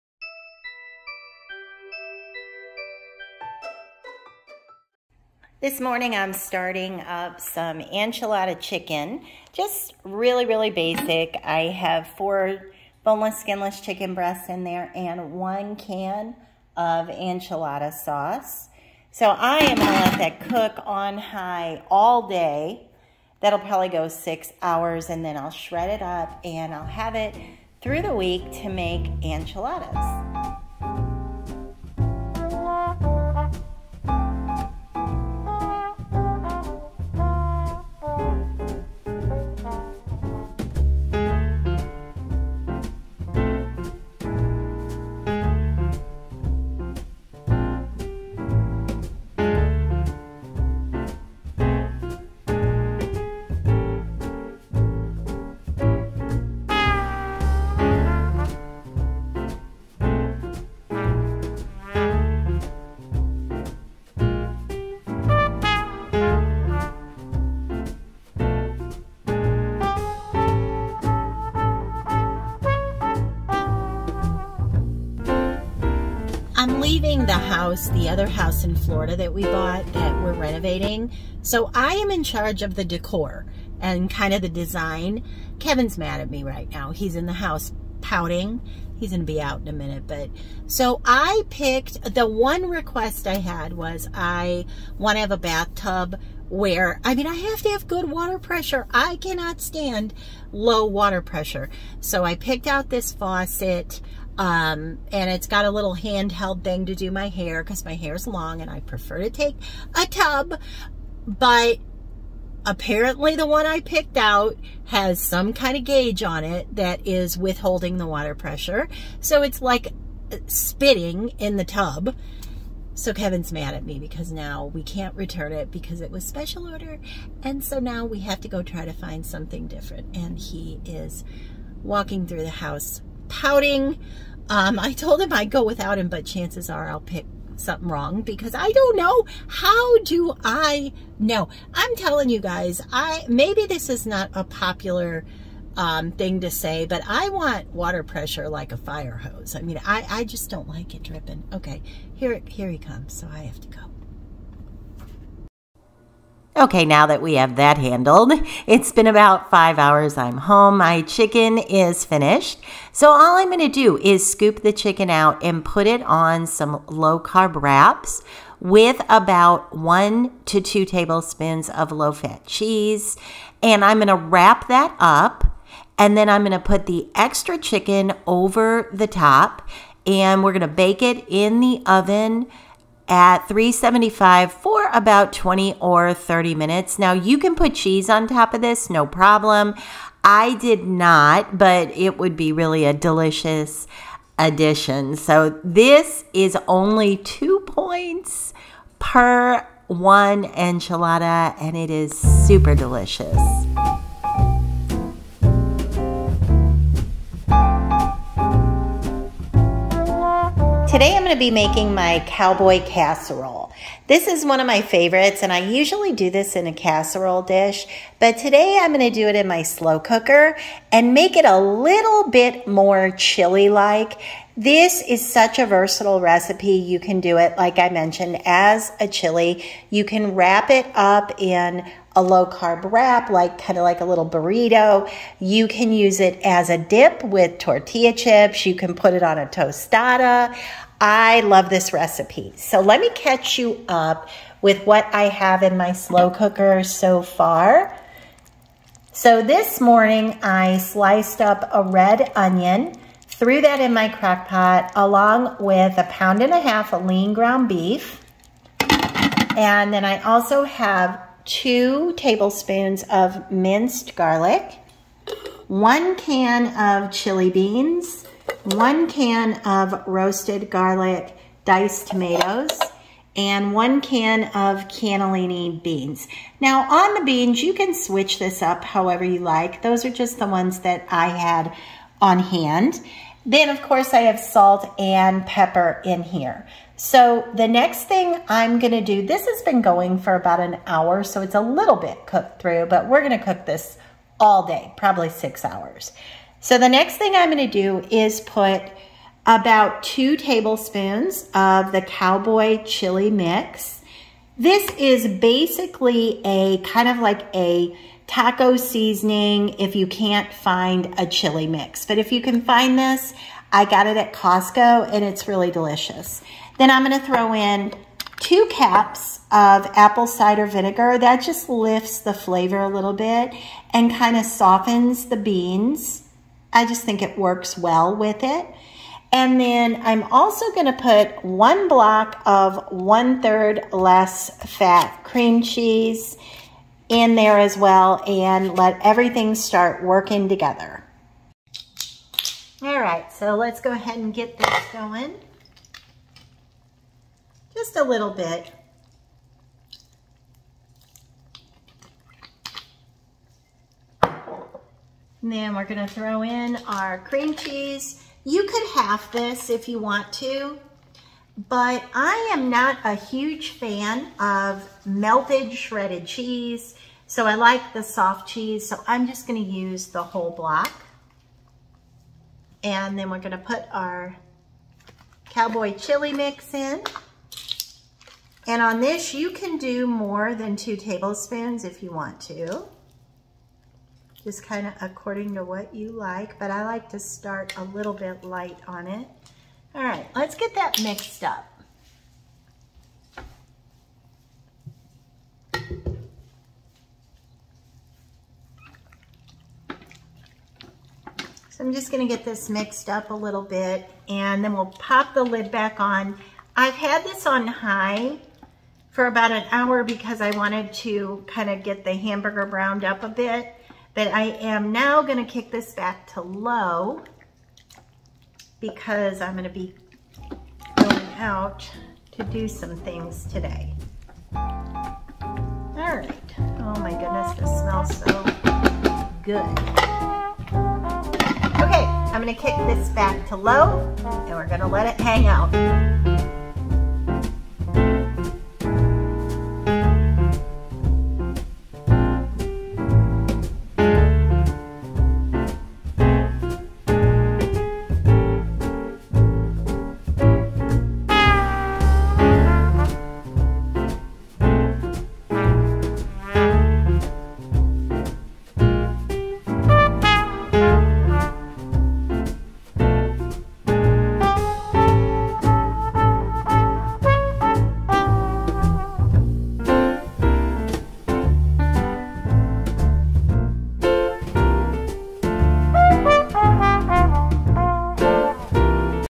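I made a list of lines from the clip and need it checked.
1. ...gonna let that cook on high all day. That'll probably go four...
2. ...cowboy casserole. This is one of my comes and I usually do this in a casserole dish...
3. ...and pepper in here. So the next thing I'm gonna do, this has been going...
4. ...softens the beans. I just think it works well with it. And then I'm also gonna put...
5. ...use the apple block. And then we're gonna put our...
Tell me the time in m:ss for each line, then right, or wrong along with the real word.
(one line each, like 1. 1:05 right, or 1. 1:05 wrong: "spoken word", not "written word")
1. 0:19 wrong: "six", not "four"
2. 3:32 wrong: "favorites", not "comes"
3. 4:44 right
4. 5:24 right
5. 6:09 wrong: "whole", not "apple".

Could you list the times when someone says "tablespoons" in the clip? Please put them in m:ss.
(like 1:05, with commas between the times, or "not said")
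2:50, 4:22, 5:00, 6:20.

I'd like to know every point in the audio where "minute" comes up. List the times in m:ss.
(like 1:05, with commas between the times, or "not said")
1:29, 3:06.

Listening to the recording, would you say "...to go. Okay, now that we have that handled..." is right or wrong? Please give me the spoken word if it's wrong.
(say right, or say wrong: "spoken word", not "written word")
right.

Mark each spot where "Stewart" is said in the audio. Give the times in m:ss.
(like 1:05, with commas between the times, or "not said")
not said.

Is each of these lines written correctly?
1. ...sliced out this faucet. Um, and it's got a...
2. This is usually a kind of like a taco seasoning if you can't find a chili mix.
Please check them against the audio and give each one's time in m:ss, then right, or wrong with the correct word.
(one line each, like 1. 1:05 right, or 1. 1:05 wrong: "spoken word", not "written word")
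1. 1:42 wrong: "picked", not "sliced"
2. 5:04 wrong: "basically", not "usually".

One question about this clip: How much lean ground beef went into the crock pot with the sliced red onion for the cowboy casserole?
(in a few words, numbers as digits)
a pound and a half.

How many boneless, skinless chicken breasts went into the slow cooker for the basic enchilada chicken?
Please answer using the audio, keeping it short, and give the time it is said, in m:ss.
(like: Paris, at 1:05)
4, at 0:12.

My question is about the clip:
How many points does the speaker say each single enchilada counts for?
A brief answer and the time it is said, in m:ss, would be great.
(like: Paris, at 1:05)
2, at 3:17.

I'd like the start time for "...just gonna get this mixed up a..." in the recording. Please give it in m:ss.
6:41.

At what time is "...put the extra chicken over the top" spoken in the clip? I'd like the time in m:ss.
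2:56.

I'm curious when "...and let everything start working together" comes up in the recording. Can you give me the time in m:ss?
5:38.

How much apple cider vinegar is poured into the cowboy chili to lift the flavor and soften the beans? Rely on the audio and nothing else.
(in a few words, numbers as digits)
2 cups.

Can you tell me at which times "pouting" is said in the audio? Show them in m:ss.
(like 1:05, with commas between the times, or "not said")
1:28, 2:13.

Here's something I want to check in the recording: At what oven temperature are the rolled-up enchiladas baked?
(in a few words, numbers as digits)
375.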